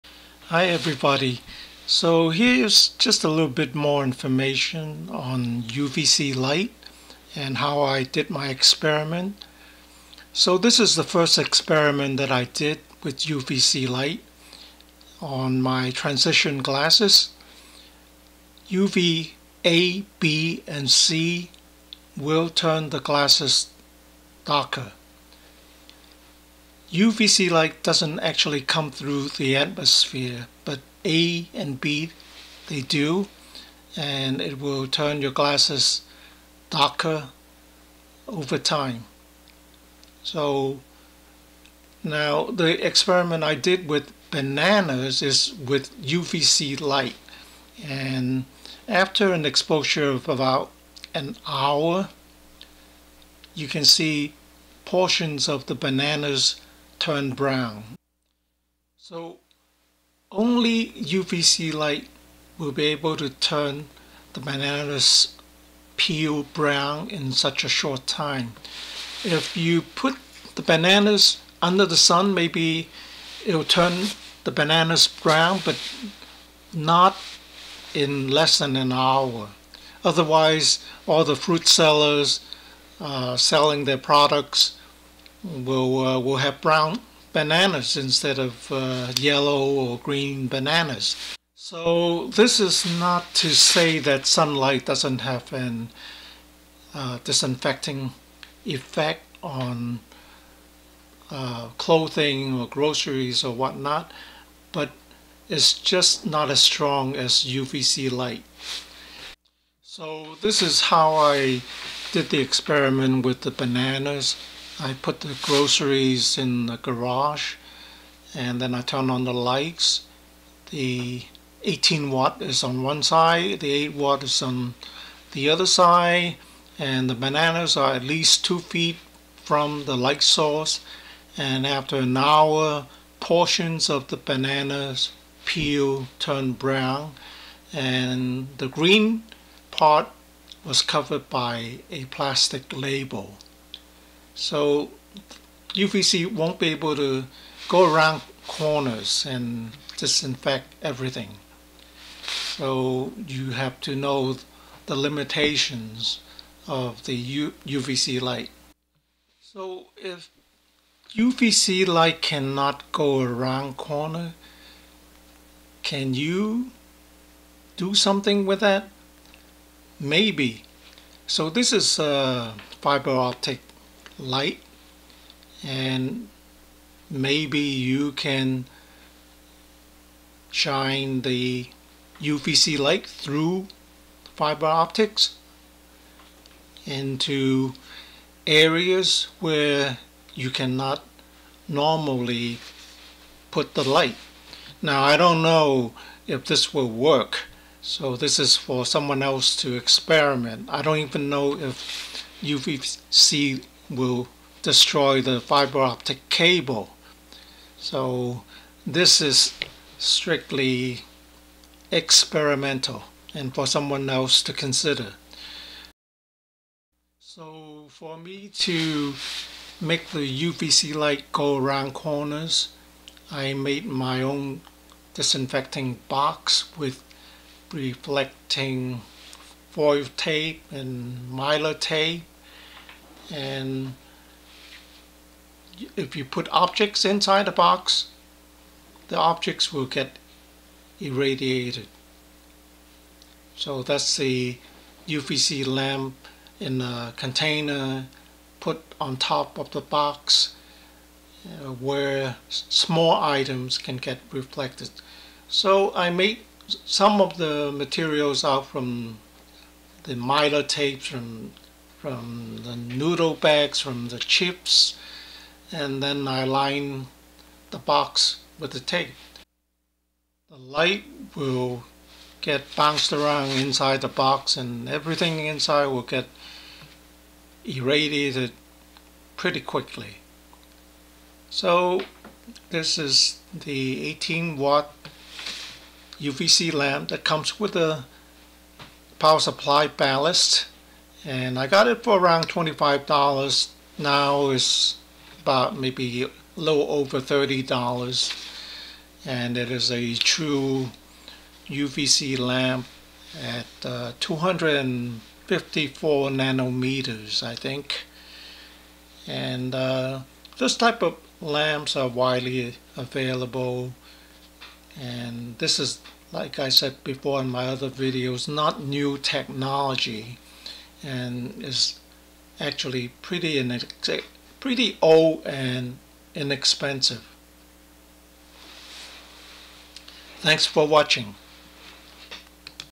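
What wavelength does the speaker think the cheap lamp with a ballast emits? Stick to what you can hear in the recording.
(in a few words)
254 nanometers.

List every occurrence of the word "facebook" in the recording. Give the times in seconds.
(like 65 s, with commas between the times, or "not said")
not said.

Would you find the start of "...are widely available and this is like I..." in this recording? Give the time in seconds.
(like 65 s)
311 s.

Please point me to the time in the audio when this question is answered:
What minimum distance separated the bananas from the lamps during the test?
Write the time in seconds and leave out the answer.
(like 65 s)
128 s.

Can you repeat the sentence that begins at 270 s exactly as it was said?
The light will get bounced around inside the box and everything inside will get irradiated pretty quickly.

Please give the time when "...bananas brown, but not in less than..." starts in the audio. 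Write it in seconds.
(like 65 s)
74 s.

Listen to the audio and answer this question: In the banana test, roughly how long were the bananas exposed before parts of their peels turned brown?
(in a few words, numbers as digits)
about an hour.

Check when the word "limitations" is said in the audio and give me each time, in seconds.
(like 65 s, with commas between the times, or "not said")
154 s.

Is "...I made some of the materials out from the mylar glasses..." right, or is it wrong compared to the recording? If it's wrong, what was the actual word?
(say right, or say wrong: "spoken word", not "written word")
wrong: "tapes", not "glasses".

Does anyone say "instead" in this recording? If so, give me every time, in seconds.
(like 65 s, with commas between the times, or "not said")
87 s.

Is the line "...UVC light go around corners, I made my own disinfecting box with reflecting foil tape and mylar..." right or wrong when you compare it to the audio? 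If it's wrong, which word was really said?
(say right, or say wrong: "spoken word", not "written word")
right.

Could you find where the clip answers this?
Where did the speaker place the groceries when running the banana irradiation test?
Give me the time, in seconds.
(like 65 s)
116 s.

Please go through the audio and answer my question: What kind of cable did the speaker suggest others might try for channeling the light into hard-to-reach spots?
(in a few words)
fiber optics.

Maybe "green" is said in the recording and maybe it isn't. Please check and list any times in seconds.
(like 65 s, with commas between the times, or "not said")
89 s, 138 s.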